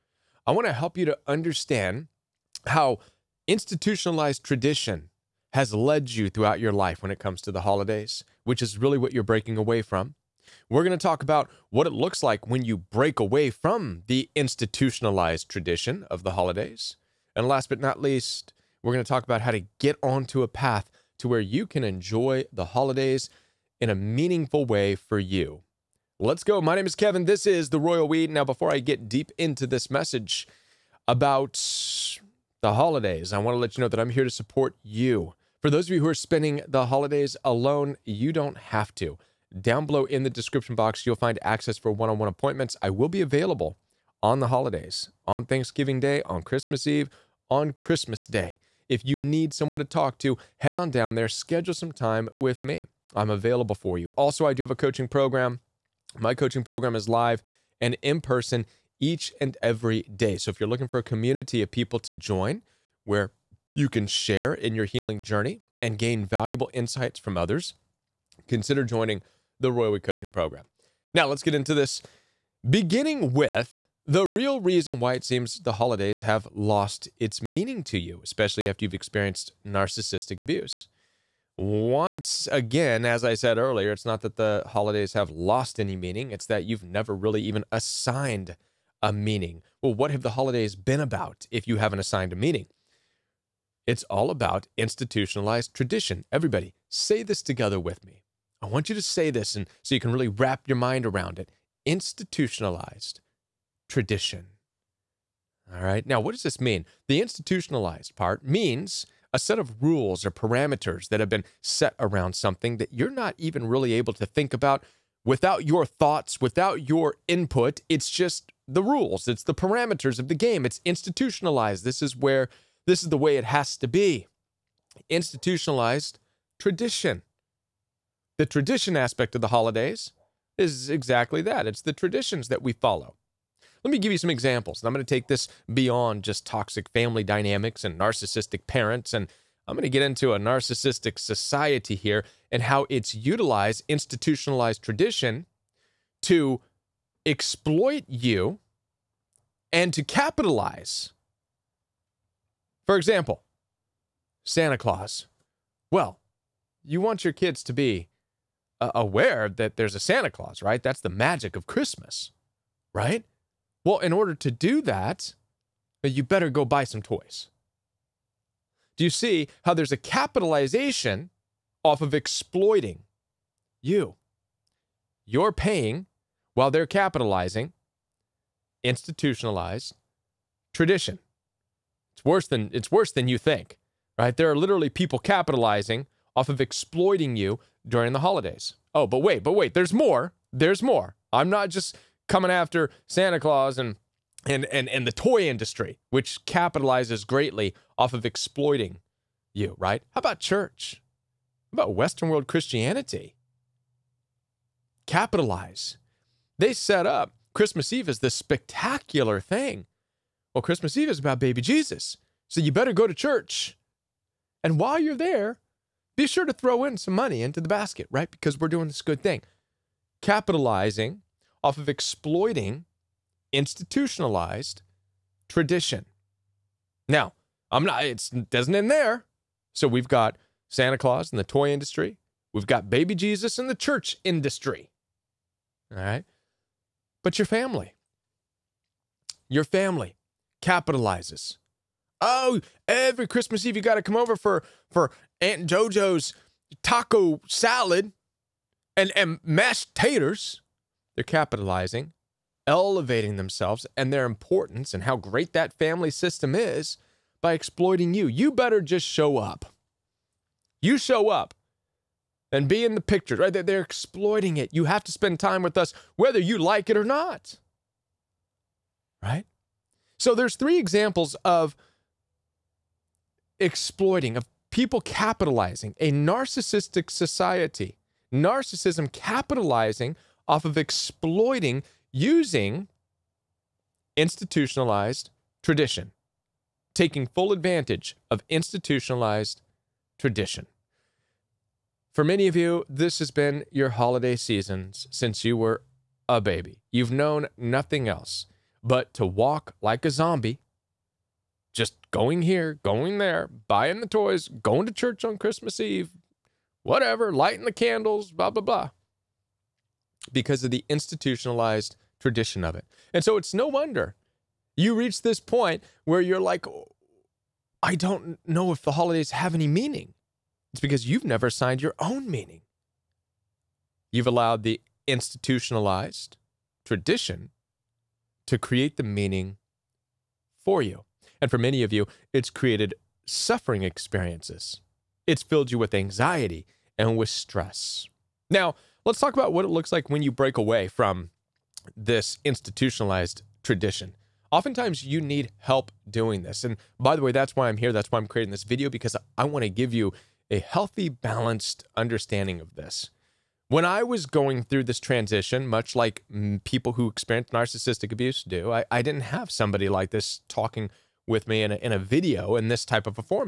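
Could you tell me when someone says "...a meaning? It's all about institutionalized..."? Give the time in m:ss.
1:32.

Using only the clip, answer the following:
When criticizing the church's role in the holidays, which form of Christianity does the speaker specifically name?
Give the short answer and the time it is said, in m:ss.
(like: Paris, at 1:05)
Western world Christianity, at 3:21.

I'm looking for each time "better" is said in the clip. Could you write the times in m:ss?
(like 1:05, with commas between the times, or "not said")
2:46, 3:32, 4:18.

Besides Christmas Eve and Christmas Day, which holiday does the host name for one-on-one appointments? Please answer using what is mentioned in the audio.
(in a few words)
Thanksgiving Day.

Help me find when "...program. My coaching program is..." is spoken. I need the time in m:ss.
0:55.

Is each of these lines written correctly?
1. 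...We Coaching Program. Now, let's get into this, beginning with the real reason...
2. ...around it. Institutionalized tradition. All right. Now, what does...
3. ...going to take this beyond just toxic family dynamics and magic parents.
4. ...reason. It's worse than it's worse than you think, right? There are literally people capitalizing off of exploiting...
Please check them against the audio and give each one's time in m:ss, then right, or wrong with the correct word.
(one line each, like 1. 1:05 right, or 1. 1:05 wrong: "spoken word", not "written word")
1. 1:09 right
2. 1:41 right
3. 2:14 wrong: "narcissistic", not "magic"
4. 3:00 wrong: "tradition", not "reason".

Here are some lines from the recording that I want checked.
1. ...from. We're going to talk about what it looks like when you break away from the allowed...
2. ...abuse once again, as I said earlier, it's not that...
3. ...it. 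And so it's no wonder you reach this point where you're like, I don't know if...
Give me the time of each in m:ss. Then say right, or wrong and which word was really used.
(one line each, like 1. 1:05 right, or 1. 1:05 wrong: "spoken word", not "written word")
1. 0:09 wrong: "institutionalized", not "allowed"
2. 1:20 right
3. 5:12 right.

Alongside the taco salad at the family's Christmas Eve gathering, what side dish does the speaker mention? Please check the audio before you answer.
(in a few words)
mashed taters.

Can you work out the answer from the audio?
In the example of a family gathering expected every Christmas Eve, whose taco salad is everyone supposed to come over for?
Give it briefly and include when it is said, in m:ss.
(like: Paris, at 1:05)
Aunt JoJo, at 4:05.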